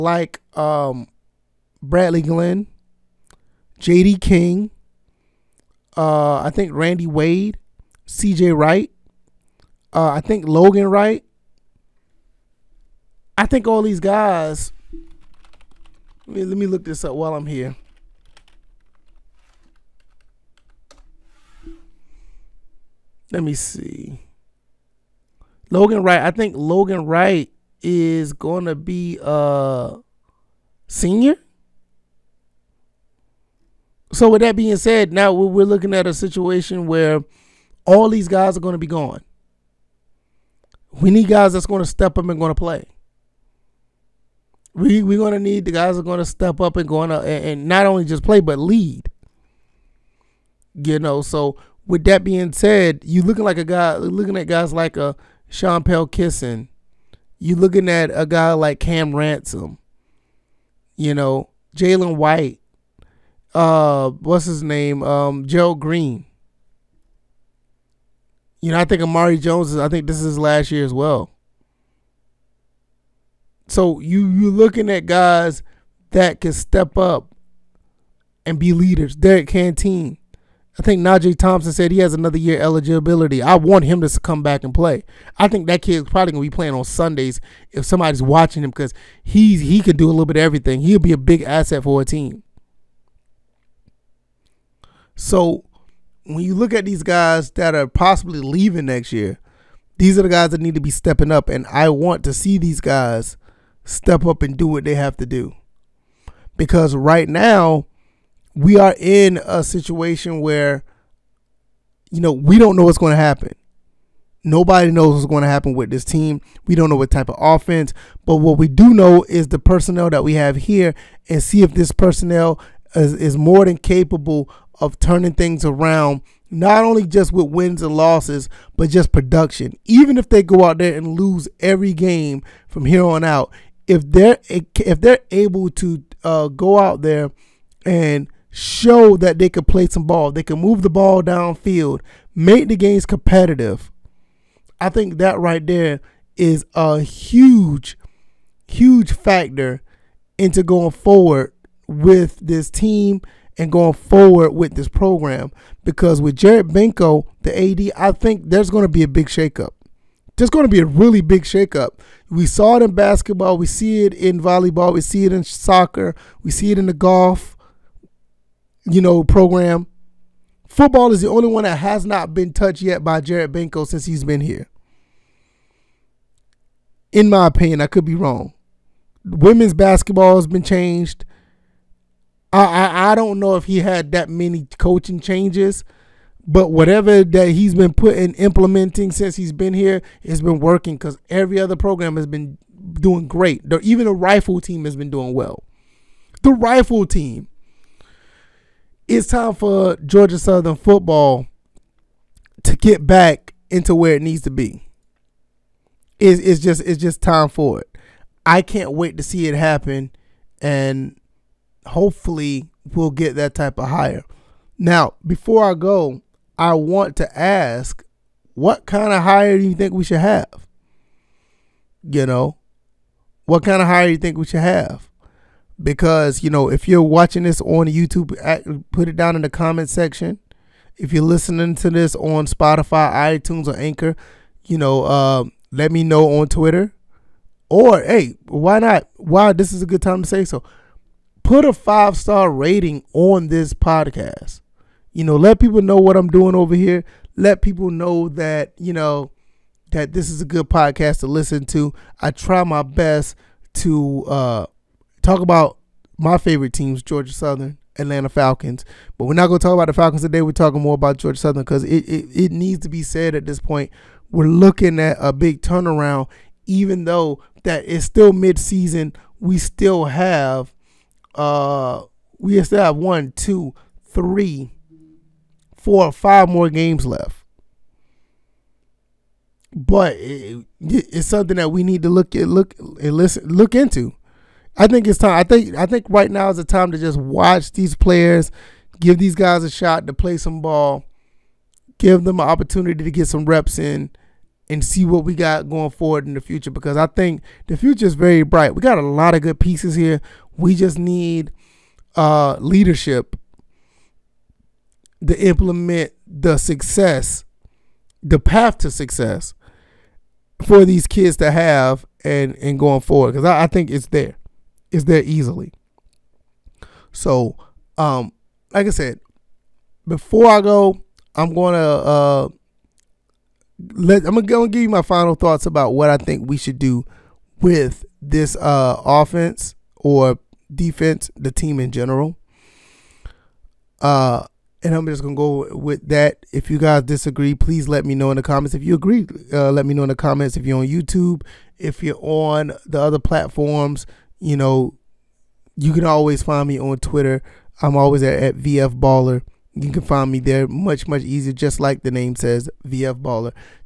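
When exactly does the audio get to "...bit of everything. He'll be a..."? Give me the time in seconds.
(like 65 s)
90 s.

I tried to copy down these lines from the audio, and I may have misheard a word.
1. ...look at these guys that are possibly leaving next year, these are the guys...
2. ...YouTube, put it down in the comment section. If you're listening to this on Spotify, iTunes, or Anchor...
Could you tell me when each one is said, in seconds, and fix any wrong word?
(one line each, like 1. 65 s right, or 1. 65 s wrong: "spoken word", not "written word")
1. 96 s right
2. 227 s right.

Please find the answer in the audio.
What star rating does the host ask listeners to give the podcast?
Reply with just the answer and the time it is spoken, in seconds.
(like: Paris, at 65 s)
5, at 241 s.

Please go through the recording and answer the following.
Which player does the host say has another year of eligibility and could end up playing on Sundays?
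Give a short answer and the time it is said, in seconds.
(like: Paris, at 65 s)
Najee Thompson, at 81 s.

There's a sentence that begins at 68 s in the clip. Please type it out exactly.
You know, I think Amare Jones is.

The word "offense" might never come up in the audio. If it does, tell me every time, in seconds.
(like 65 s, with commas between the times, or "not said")
117 s, 329 s.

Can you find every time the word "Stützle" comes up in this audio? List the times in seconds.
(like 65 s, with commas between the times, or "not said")
not said.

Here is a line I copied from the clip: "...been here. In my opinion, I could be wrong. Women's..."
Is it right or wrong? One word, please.
right.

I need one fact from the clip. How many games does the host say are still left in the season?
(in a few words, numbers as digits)
5.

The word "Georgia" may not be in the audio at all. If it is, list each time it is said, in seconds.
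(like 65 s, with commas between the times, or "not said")
199 s, 257 s, 261 s.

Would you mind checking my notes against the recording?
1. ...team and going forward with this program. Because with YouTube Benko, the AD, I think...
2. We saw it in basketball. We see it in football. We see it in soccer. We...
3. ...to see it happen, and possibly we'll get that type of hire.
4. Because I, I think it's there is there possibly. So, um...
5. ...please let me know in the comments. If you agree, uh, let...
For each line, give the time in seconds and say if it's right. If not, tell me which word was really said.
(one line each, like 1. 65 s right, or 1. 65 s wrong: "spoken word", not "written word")
1. 152 s wrong: "Jared", not "YouTube"
2. 162 s wrong: "volleyball", not "football"
3. 209 s wrong: "hopefully", not "possibly"
4. 313 s wrong: "easily", not "possibly"
5. 337 s right.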